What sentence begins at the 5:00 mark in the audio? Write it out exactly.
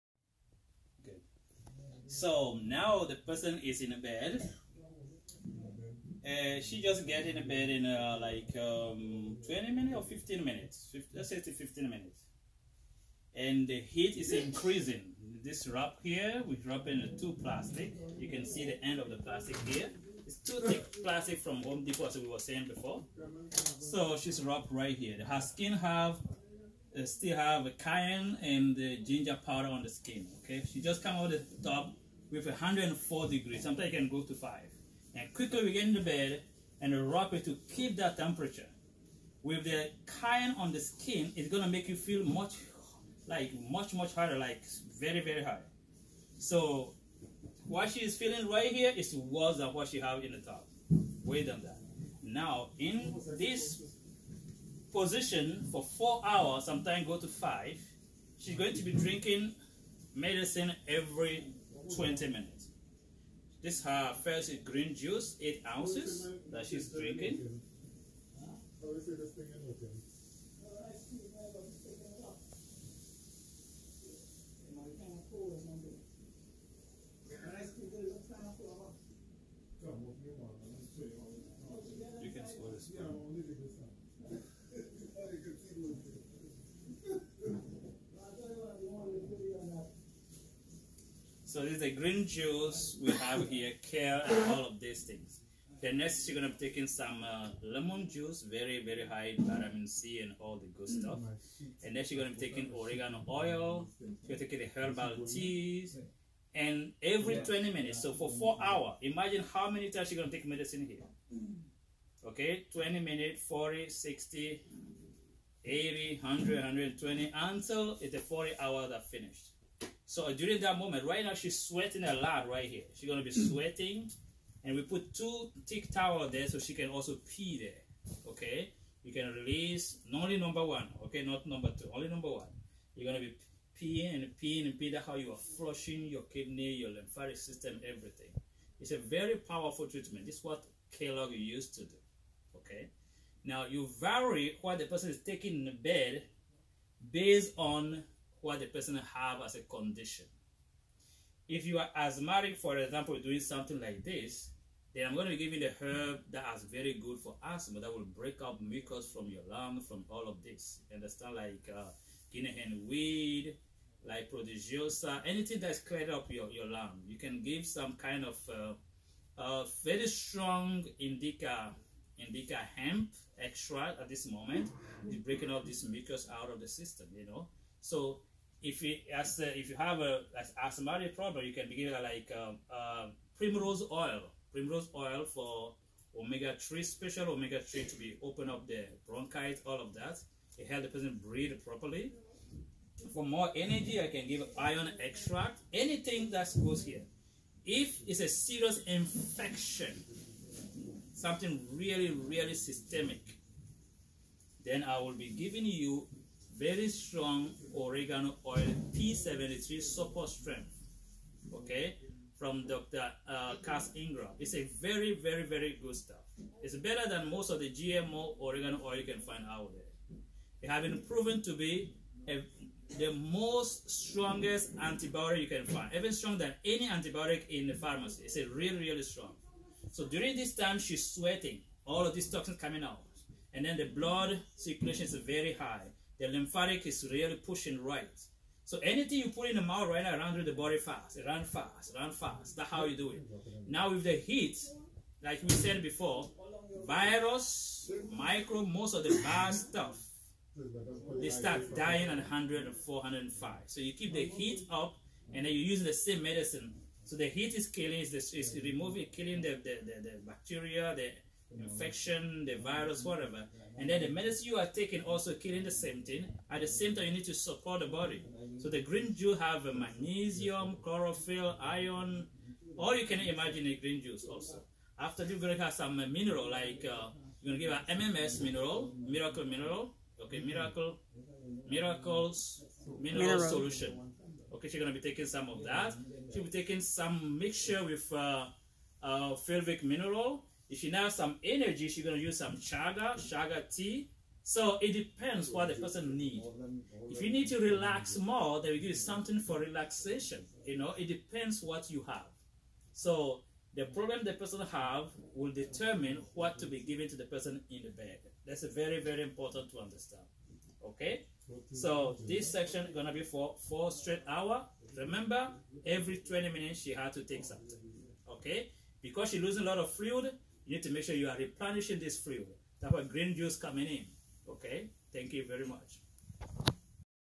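You know, it depends what you have.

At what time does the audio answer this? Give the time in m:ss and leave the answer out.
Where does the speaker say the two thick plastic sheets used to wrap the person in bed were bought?
0:21.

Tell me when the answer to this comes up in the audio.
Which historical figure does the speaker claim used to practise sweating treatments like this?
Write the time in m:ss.
2:20.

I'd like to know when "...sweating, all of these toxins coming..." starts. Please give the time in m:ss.
3:51.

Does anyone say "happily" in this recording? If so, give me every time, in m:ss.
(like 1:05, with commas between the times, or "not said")
not said.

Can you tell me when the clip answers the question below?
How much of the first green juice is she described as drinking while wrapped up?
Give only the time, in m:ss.
1:05.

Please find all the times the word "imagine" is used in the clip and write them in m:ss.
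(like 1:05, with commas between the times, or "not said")
1:49, 4:33.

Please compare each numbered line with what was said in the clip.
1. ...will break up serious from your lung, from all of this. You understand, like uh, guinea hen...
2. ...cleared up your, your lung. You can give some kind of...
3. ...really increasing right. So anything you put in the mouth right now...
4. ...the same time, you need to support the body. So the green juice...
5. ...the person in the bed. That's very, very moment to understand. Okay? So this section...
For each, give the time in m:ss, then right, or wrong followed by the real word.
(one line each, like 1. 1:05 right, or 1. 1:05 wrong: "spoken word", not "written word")
1. 2:37 wrong: "mucus", not "serious"
2. 2:45 right
3. 3:57 wrong: "pushing", not "increasing"
4. 4:26 right
5. 5:07 wrong: "important", not "moment".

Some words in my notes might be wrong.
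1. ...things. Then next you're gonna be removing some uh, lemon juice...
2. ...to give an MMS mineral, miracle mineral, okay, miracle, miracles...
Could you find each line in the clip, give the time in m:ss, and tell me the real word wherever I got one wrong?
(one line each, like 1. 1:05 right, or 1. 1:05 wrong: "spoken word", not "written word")
1. 1:35 wrong: "taking", not "removing"
2. 4:37 right.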